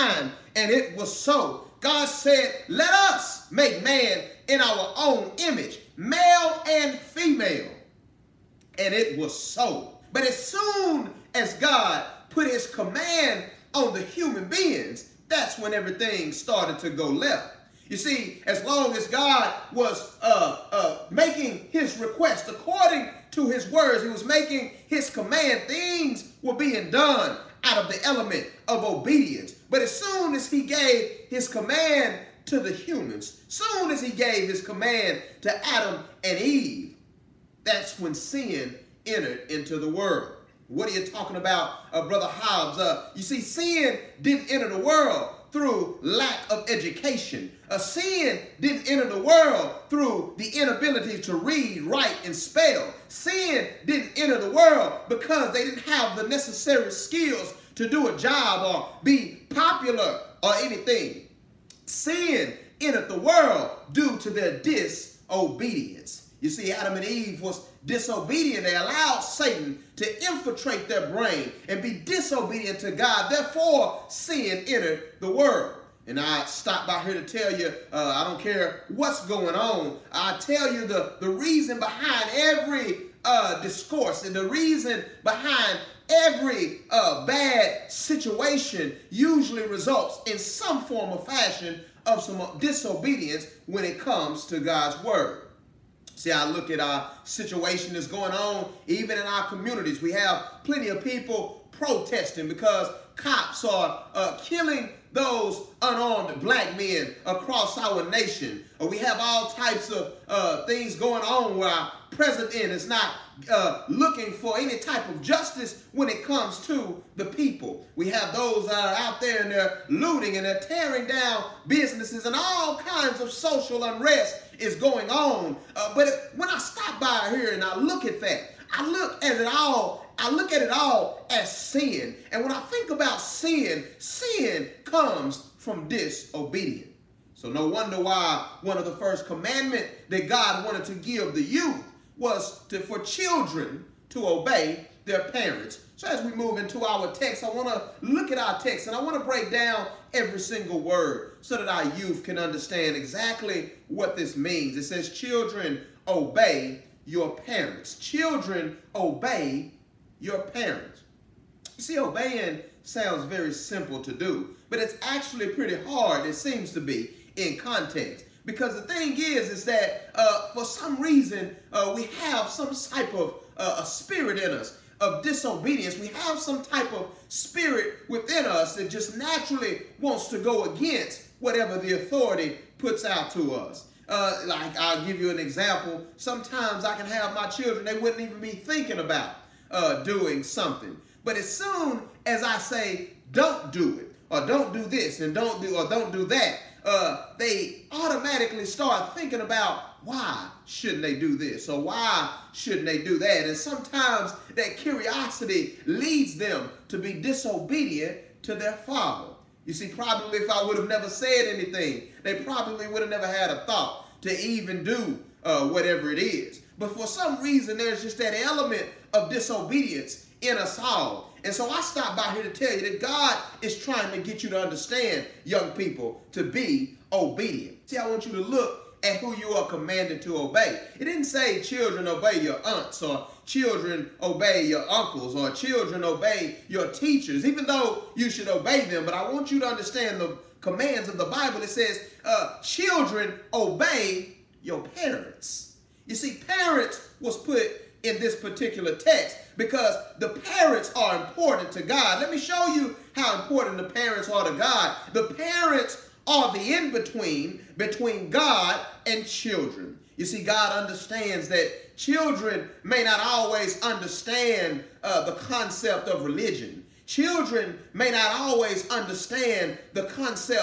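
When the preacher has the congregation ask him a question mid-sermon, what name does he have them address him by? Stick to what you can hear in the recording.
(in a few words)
Brother Hobbs.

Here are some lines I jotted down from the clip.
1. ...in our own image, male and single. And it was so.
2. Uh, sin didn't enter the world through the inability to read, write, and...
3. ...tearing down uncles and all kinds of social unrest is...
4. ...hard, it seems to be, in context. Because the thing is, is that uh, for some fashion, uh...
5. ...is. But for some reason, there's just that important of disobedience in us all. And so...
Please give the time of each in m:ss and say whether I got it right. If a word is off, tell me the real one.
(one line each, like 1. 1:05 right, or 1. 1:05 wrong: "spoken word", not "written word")
1. 0:04 wrong: "female", not "single"
2. 0:47 right
3. 2:00 wrong: "businesses", not "uncles"
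4. 2:45 wrong: "reason", not "fashion"
5. 3:36 wrong: "element", not "important".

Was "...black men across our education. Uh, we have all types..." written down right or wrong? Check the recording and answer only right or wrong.
wrong.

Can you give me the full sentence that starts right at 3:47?
See, I want you to look at who you are commanded to obey.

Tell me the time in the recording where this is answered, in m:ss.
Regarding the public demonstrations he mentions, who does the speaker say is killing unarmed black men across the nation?
1:43.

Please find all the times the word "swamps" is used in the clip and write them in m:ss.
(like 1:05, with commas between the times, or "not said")
not said.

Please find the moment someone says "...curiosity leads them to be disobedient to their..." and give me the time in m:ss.
3:24.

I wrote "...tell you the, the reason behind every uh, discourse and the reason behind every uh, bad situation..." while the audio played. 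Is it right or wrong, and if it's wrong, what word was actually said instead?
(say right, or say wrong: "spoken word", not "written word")
right.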